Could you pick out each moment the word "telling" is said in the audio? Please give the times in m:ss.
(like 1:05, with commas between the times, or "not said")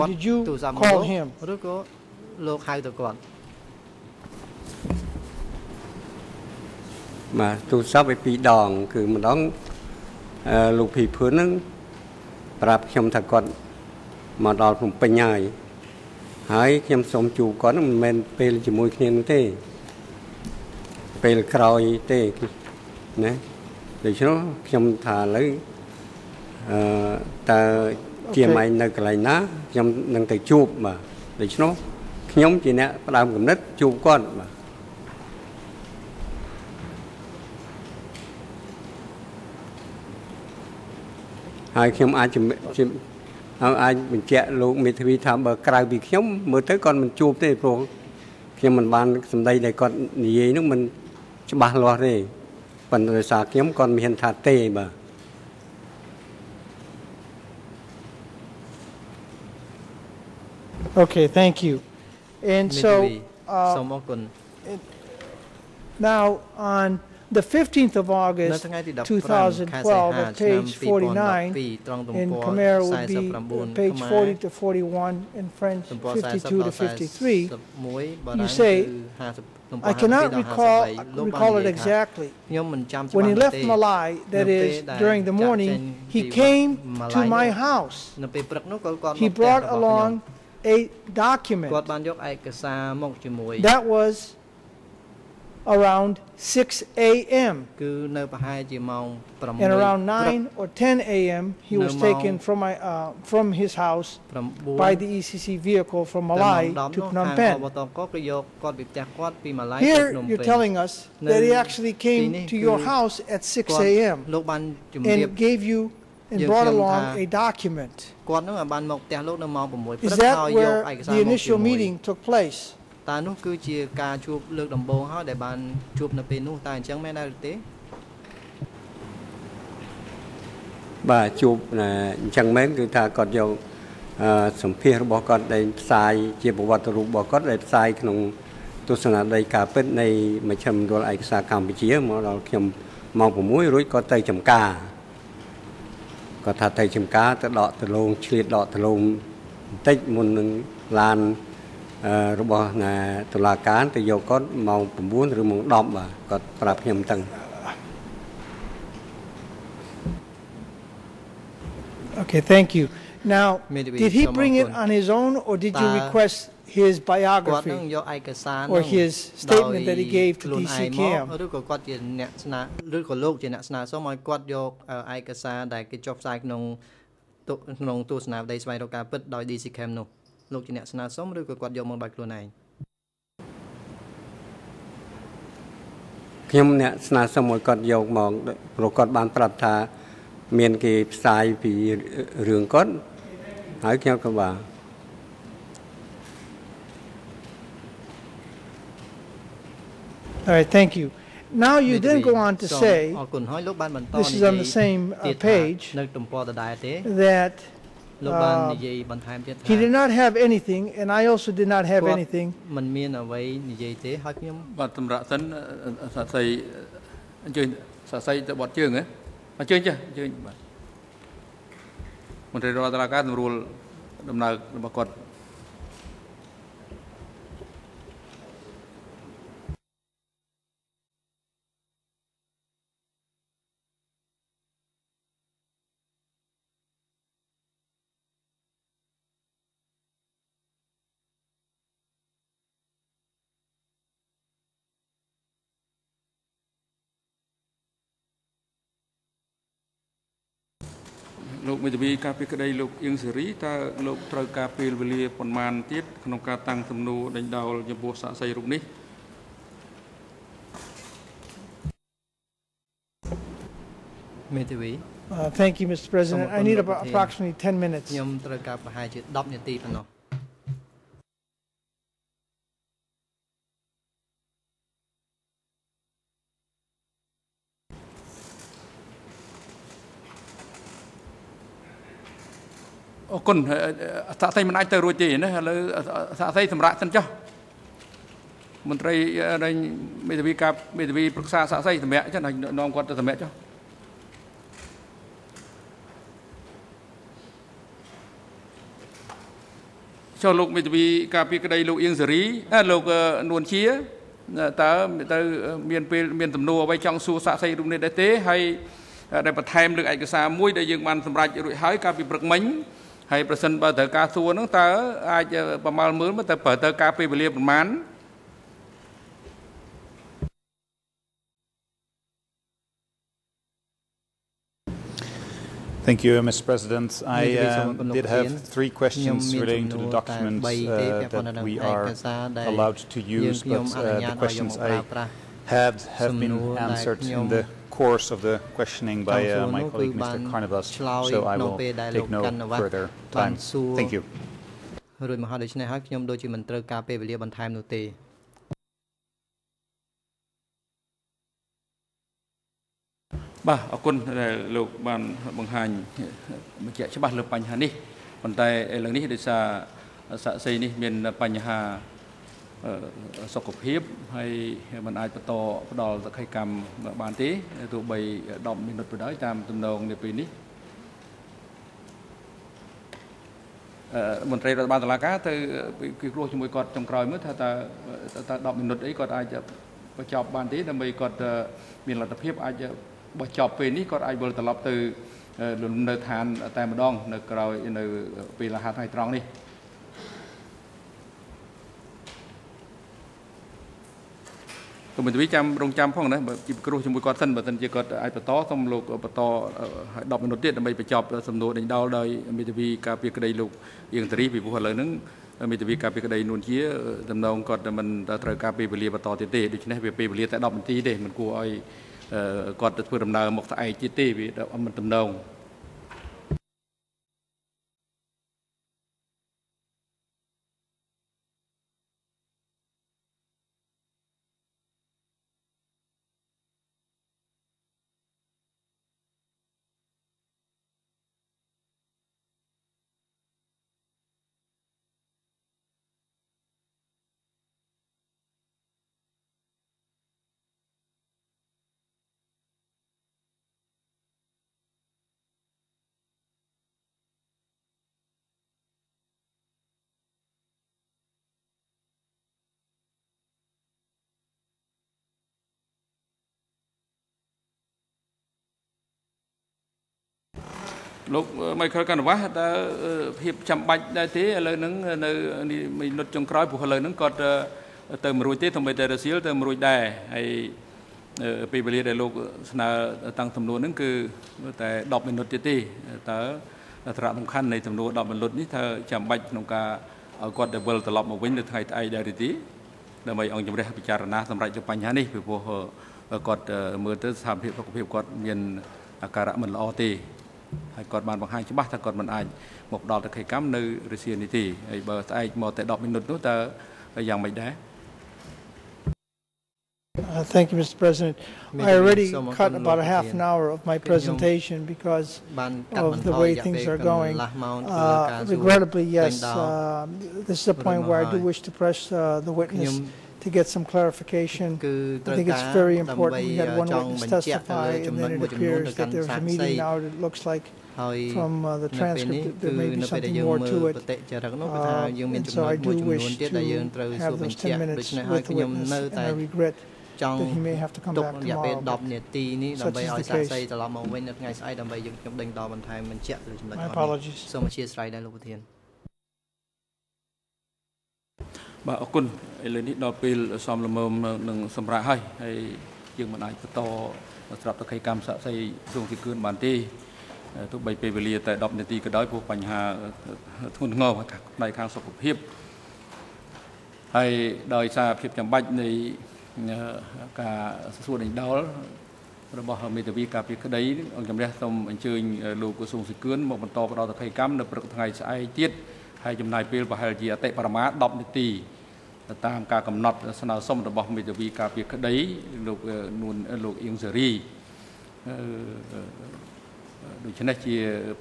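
1:50.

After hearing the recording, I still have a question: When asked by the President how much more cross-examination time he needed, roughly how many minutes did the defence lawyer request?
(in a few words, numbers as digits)
10.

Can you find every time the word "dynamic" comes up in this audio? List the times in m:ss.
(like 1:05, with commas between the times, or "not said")
not said.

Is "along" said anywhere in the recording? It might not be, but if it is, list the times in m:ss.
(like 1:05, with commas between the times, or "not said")
1:29, 1:56.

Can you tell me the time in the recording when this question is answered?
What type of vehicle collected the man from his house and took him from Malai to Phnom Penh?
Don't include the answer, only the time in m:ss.
1:45.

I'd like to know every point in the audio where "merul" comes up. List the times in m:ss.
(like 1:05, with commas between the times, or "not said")
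3:43.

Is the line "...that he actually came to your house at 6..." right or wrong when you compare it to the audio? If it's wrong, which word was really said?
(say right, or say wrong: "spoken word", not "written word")
right.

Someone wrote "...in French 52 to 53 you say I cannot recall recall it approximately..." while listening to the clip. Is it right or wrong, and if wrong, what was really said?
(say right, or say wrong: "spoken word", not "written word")
wrong: "exactly", not "approximately".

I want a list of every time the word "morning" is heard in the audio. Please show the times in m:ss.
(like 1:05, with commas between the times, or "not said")
1:25.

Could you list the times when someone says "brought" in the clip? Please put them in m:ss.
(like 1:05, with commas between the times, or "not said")
1:29, 1:56.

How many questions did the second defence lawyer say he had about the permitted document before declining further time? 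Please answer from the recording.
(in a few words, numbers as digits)
3.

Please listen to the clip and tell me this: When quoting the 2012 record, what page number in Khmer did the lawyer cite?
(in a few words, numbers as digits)
49.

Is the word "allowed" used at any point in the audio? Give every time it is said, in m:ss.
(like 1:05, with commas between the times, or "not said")
5:32.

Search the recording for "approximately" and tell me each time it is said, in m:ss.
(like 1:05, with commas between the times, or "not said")
4:27.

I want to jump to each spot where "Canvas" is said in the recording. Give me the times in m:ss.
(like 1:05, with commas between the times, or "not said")
7:42.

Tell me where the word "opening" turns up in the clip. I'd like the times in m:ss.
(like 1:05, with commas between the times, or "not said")
not said.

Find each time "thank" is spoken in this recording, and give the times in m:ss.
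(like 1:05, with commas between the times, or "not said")
1:01, 2:42, 3:20, 4:25, 5:13, 5:43, 8:20.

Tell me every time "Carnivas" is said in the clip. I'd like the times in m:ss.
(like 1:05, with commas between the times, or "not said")
5:40.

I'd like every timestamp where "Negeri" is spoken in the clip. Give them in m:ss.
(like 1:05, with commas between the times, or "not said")
3:42.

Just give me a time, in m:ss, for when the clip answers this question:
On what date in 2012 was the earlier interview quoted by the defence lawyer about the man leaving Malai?
1:07.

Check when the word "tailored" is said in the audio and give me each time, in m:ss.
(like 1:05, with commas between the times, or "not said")
not said.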